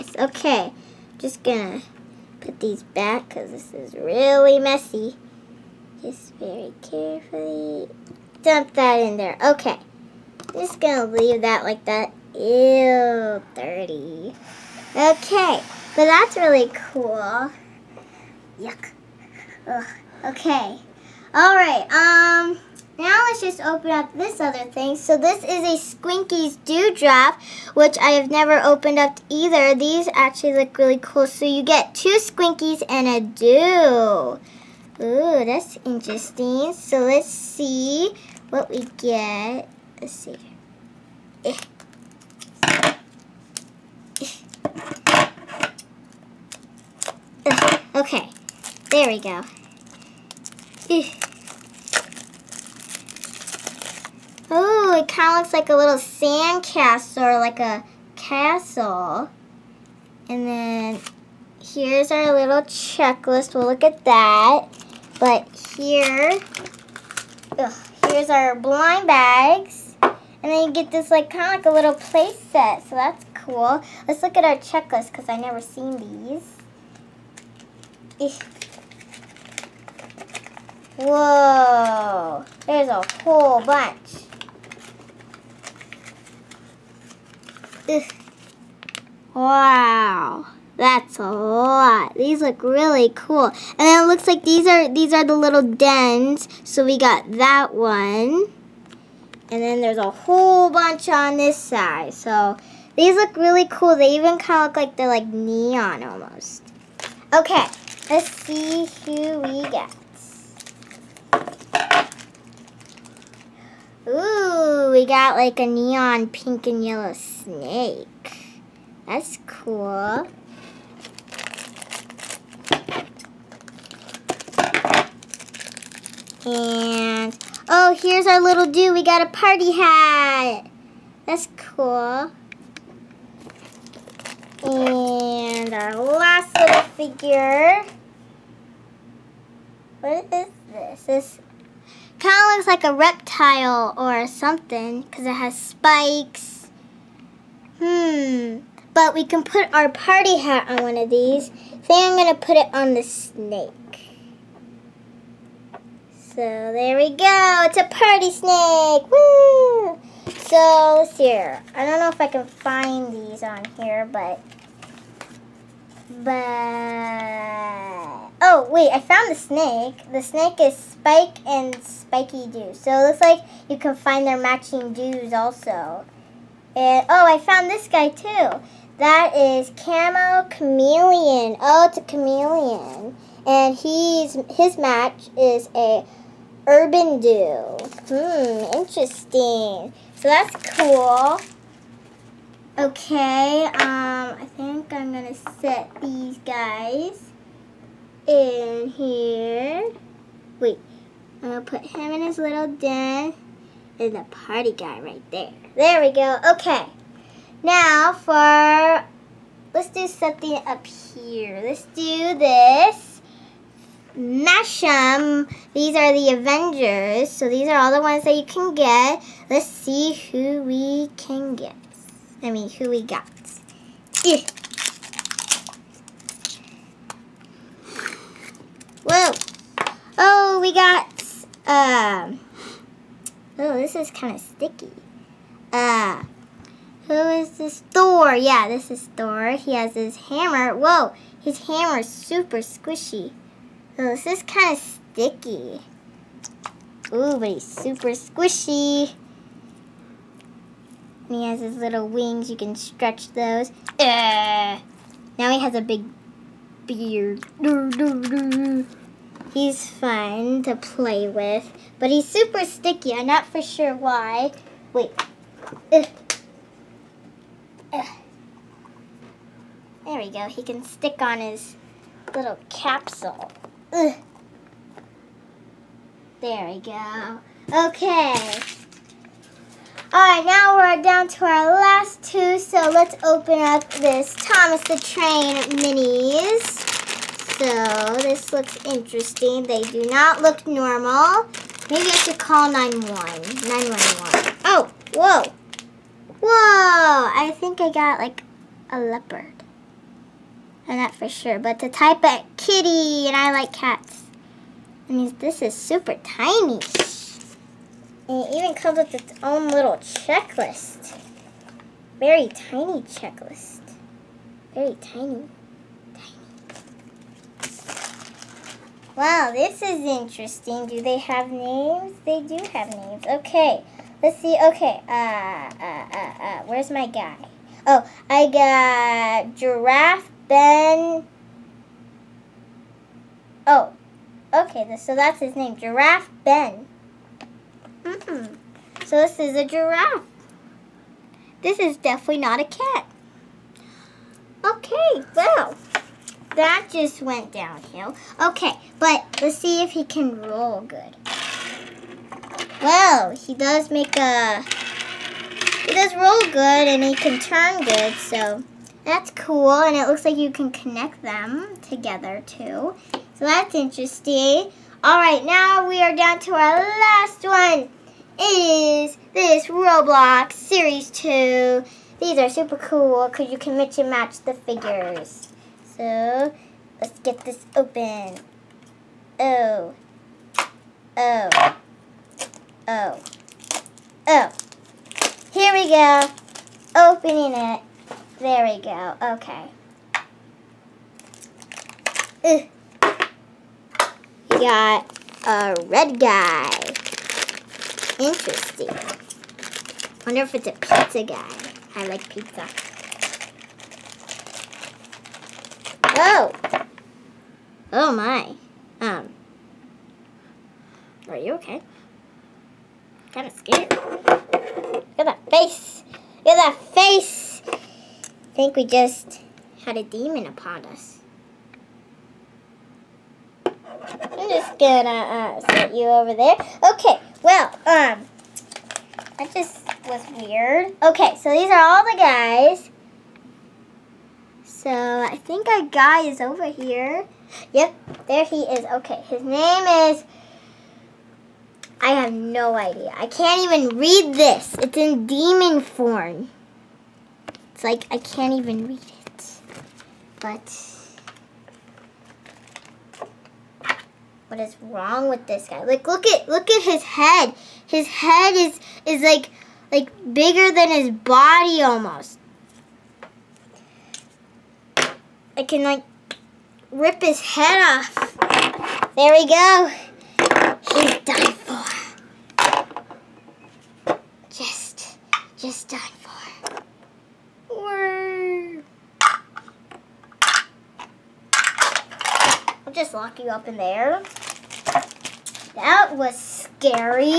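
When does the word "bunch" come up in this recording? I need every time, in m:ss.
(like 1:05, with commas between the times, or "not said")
1:23, 1:40.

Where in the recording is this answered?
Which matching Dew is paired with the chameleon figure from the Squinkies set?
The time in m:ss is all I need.
3:06.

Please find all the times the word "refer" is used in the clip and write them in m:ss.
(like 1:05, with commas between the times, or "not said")
not said.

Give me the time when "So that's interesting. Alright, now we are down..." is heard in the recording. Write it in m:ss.
6:03.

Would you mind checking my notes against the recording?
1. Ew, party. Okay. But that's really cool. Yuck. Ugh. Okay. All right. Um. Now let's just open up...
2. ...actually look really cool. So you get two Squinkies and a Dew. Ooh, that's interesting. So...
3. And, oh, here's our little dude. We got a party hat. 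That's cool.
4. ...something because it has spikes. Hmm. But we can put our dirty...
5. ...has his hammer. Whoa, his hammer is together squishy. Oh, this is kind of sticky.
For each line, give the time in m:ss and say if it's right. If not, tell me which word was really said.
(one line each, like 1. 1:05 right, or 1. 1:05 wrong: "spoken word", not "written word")
1. 0:12 wrong: "dirty", not "party"
2. 0:30 right
3. 2:06 right
4. 2:24 wrong: "party", not "dirty"
5. 3:59 wrong: "super", not "together".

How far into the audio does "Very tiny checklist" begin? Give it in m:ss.
5:12.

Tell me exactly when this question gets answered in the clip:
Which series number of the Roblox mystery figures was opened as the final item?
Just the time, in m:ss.
6:10.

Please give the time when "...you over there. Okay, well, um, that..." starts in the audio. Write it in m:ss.
7:05.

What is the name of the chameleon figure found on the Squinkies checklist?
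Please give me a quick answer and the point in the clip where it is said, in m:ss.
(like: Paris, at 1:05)
Camo Chameleon, at 2:59.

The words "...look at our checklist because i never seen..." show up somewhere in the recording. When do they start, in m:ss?
1:14.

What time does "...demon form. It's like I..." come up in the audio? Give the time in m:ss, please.
7:25.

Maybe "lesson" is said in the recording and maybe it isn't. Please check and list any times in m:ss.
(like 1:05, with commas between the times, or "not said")
not said.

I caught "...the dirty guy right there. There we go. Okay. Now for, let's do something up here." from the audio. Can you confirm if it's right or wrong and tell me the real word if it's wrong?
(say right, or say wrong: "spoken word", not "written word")
wrong: "party", not "dirty".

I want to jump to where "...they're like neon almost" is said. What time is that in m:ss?
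1:44.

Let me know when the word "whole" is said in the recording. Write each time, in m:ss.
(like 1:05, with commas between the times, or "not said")
1:23, 1:40.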